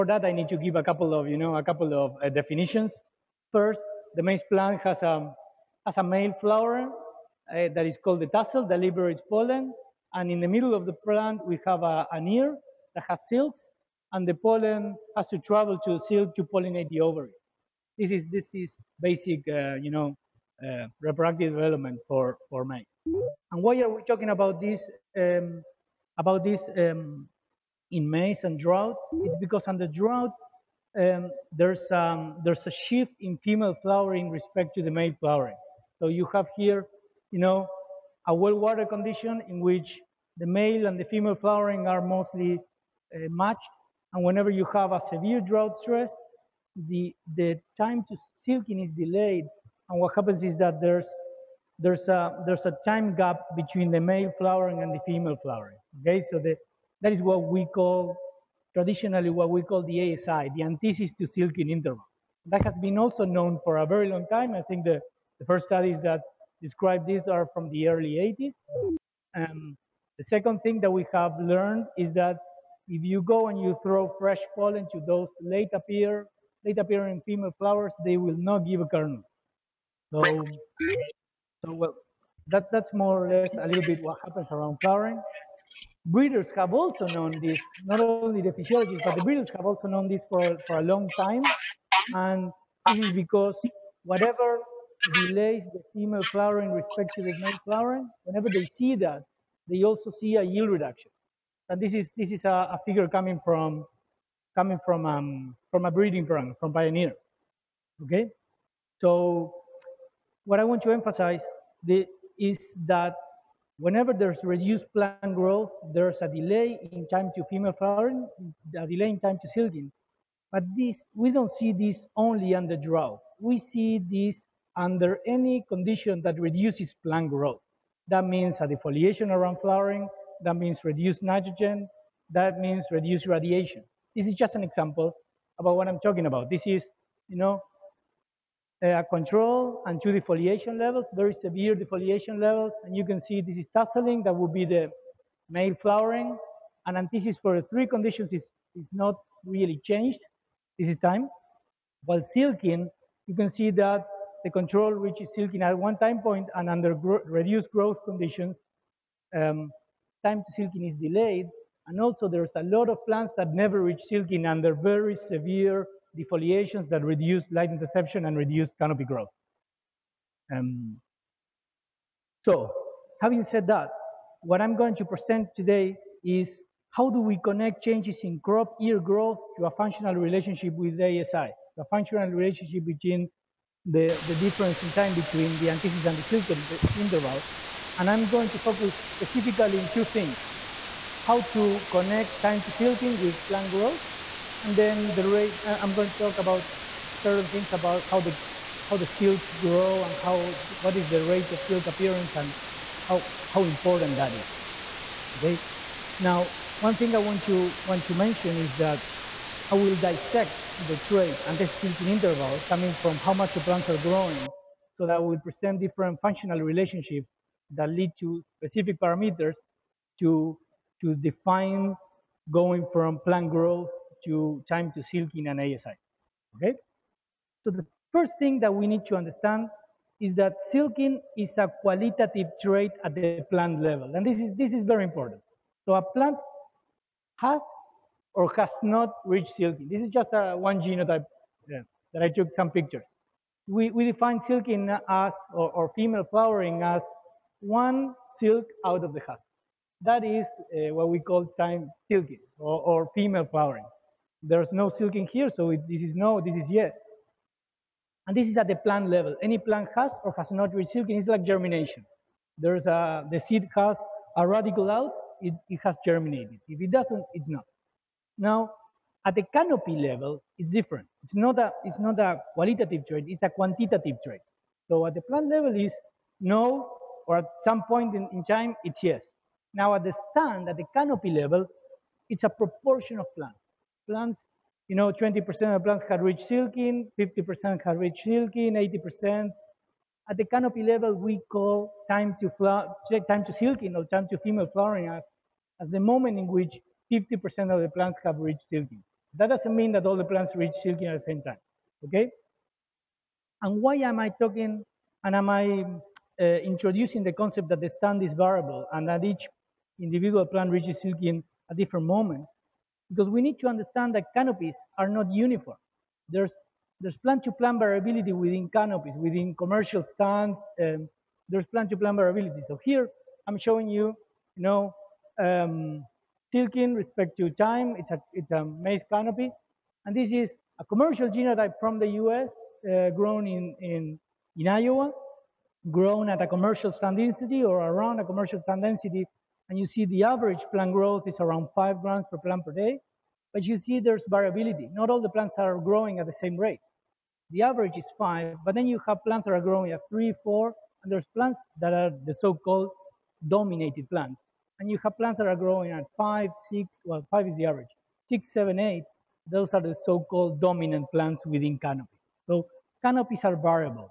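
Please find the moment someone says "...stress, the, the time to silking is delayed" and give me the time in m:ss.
0:45.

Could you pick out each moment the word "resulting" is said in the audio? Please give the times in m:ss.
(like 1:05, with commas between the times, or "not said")
not said.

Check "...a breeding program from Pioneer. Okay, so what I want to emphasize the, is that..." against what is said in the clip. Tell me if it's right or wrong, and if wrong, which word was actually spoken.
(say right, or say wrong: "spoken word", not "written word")
right.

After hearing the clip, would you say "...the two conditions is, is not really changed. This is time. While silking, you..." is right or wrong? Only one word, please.
wrong.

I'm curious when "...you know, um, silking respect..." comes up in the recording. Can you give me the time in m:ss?
5:24.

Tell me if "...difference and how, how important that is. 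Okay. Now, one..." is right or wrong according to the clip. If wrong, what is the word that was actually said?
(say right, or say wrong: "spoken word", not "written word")
wrong: "appearance", not "difference".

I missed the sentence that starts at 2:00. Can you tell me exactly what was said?
But this we don't see this only under drought.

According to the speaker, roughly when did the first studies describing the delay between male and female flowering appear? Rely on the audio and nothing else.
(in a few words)
early 80s.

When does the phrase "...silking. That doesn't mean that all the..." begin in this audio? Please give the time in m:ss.
4:58.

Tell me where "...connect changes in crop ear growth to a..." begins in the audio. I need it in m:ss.
2:57.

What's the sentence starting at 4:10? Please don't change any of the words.
That is uh, what we call time silking or, or, female flowering.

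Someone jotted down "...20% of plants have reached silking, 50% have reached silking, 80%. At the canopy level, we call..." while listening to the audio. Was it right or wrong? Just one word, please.
right.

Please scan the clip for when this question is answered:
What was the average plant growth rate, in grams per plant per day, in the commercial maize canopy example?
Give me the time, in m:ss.
5:41.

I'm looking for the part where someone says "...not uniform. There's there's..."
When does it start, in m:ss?
5:15.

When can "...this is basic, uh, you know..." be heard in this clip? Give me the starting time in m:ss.
0:18.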